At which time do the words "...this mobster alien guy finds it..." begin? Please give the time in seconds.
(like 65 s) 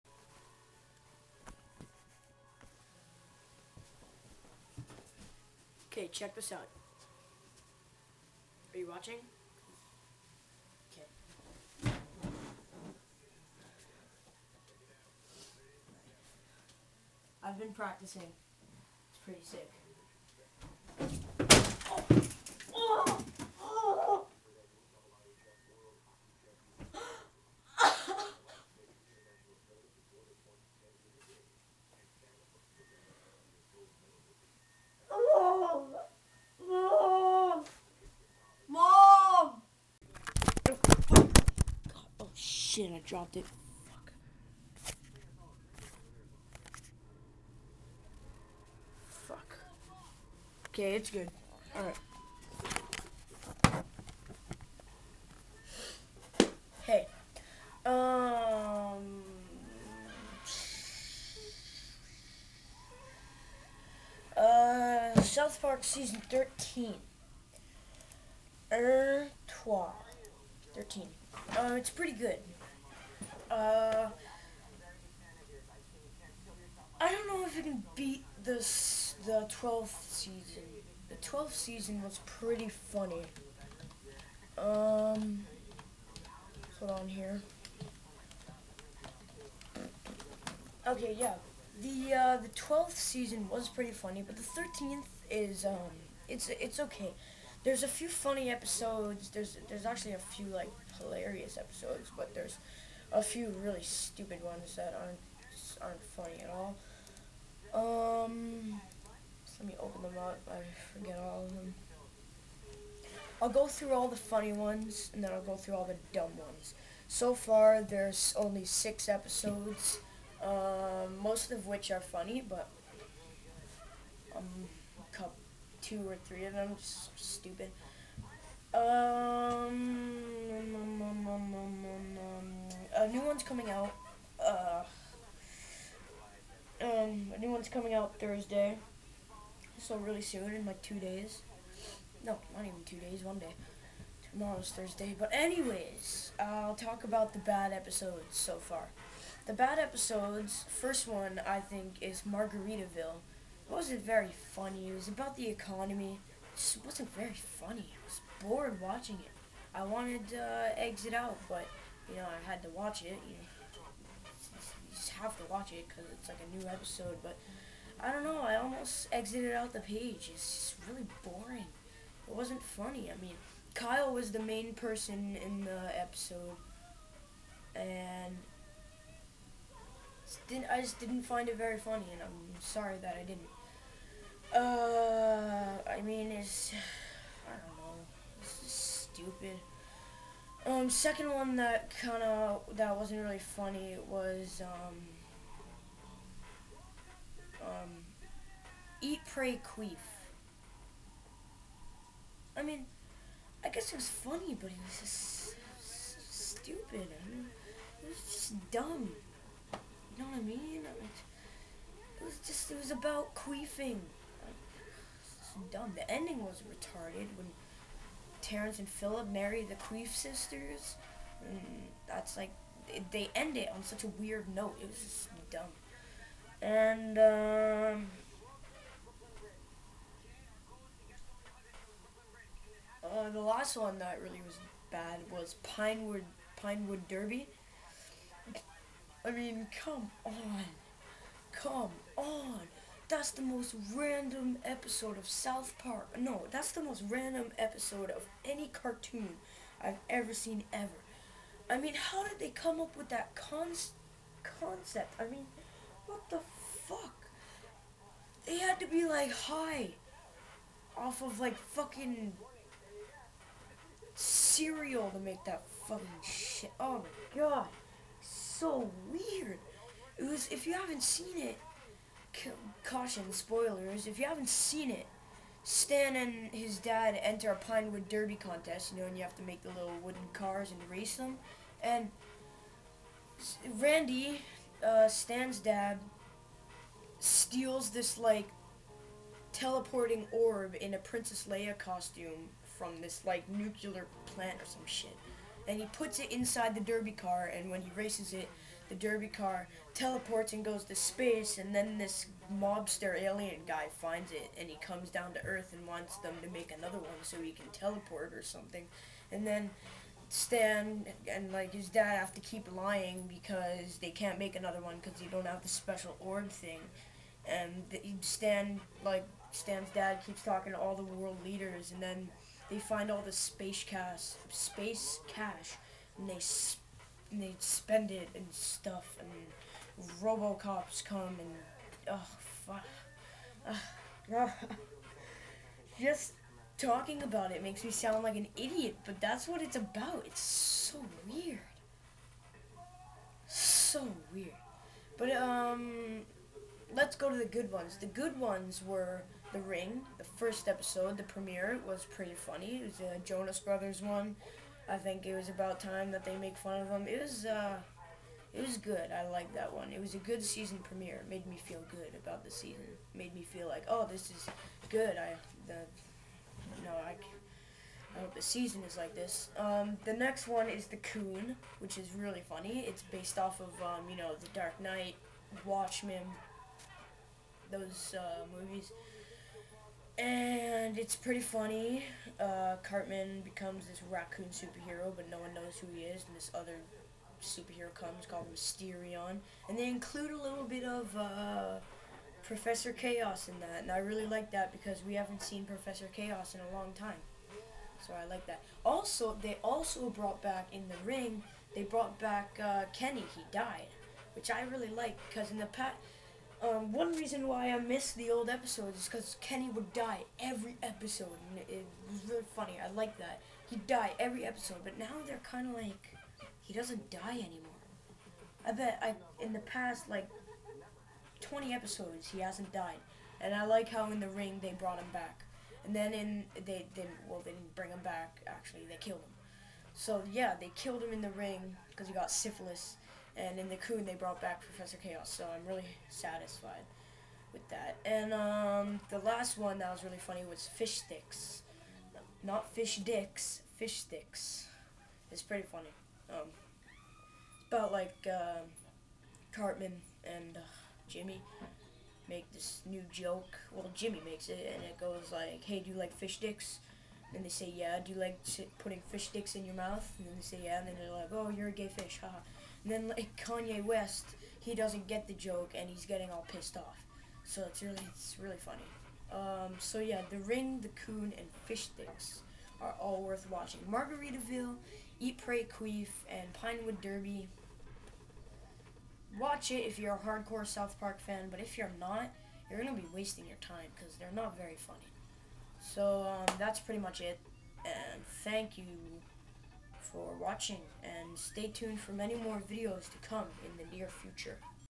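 301 s.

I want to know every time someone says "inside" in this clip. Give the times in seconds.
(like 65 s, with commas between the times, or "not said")
296 s.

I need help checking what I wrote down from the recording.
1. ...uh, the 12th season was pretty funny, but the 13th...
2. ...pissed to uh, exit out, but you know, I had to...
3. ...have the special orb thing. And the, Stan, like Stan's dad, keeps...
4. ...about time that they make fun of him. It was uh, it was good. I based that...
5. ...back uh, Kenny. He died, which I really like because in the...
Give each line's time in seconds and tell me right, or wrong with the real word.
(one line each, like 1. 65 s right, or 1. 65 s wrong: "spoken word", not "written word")
1. 92 s right
2. 159 s wrong: "wanted", not "pissed"
3. 315 s right
4. 355 s wrong: "liked", not "based"
5. 402 s right.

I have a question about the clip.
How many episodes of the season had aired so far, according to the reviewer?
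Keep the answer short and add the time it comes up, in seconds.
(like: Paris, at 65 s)
6, at 118 s.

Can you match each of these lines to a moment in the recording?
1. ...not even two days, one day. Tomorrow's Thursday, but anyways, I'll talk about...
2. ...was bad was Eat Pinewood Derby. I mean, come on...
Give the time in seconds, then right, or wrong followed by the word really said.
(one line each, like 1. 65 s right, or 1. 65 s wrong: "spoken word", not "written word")
1. 142 s right
2. 234 s wrong: "Pinewood", not "Eat".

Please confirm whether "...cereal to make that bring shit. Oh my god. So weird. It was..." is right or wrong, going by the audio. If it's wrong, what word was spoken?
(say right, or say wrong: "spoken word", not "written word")
wrong: "fucking", not "bring".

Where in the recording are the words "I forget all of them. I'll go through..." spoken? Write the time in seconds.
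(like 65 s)
110 s.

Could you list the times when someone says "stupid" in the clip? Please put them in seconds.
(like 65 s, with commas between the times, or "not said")
103 s, 127 s, 189 s, 206 s.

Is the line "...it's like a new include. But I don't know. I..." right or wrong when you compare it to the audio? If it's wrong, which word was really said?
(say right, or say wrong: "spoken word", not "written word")
wrong: "episode", not "include".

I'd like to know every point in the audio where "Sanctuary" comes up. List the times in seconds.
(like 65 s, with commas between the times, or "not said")
not said.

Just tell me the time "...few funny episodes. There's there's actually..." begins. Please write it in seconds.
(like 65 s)
97 s.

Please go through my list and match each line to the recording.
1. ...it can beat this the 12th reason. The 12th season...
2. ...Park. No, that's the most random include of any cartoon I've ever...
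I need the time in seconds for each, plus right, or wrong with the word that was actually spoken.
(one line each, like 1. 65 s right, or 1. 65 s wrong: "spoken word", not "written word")
1. 77 s wrong: "season", not "reason"
2. 245 s wrong: "episode", not "include".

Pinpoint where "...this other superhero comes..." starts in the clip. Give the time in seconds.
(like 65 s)
386 s.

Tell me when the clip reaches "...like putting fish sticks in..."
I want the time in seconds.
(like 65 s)
458 s.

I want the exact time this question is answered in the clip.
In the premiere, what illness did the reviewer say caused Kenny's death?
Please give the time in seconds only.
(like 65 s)
432 s.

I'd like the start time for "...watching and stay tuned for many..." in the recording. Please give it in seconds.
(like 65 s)
490 s.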